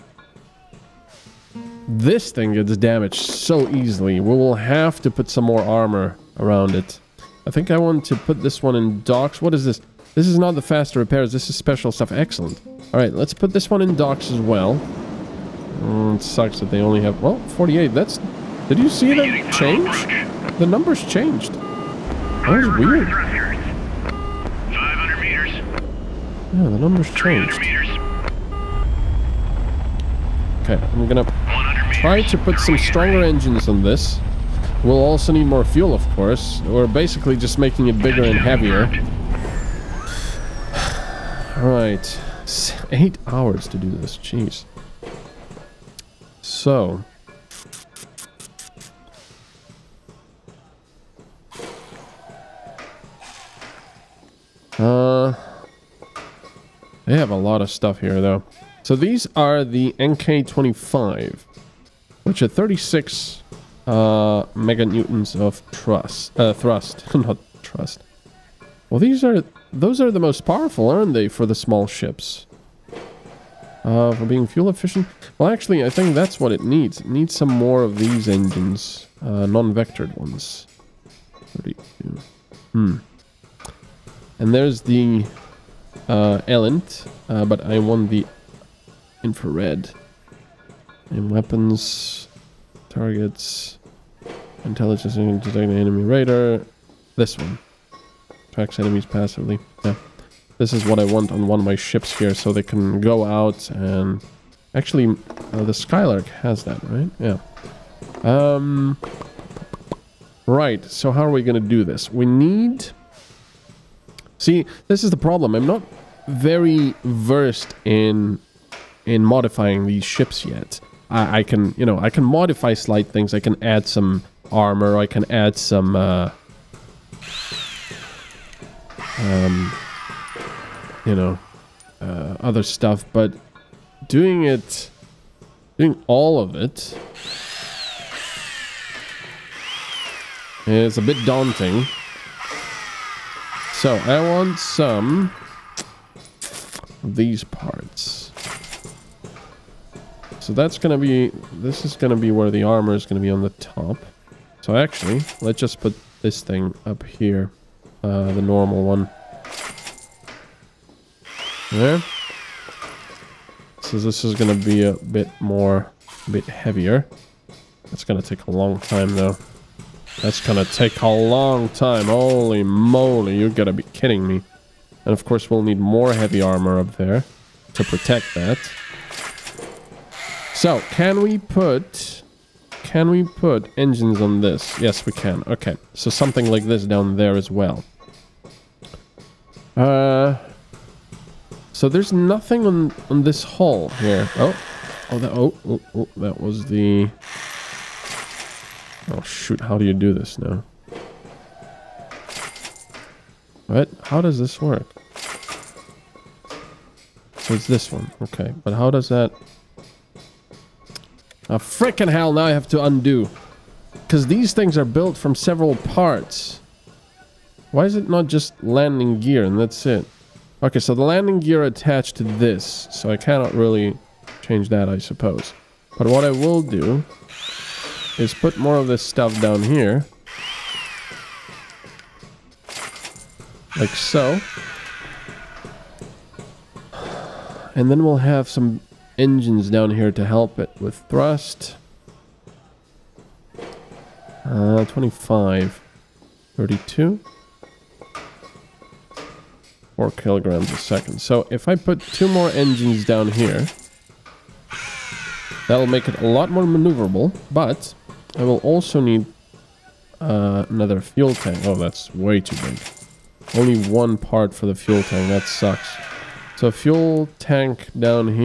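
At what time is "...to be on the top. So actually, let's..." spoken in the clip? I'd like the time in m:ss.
2:33.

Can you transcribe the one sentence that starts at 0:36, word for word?
We're basically just making it bigger and heavier.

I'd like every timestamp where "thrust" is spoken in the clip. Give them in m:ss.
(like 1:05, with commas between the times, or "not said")
1:06, 4:01.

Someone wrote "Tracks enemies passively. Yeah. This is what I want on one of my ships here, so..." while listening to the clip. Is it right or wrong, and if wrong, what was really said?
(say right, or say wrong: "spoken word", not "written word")
right.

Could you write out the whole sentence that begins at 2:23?
So I want some of these parts.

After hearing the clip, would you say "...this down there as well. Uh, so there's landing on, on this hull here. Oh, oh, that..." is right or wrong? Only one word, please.
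wrong.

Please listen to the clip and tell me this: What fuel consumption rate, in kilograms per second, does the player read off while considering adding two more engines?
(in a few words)
4 kilograms a second.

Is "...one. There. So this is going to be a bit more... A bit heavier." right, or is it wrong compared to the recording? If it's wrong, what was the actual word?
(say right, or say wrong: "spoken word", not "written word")
right.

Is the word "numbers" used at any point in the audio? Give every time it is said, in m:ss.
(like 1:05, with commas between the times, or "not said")
0:20, 0:26.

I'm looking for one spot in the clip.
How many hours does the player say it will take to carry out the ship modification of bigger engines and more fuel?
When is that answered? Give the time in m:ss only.
0:42.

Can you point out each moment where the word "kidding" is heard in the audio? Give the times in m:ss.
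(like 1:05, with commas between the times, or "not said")
2:53.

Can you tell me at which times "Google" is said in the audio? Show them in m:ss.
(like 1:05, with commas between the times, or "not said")
not said.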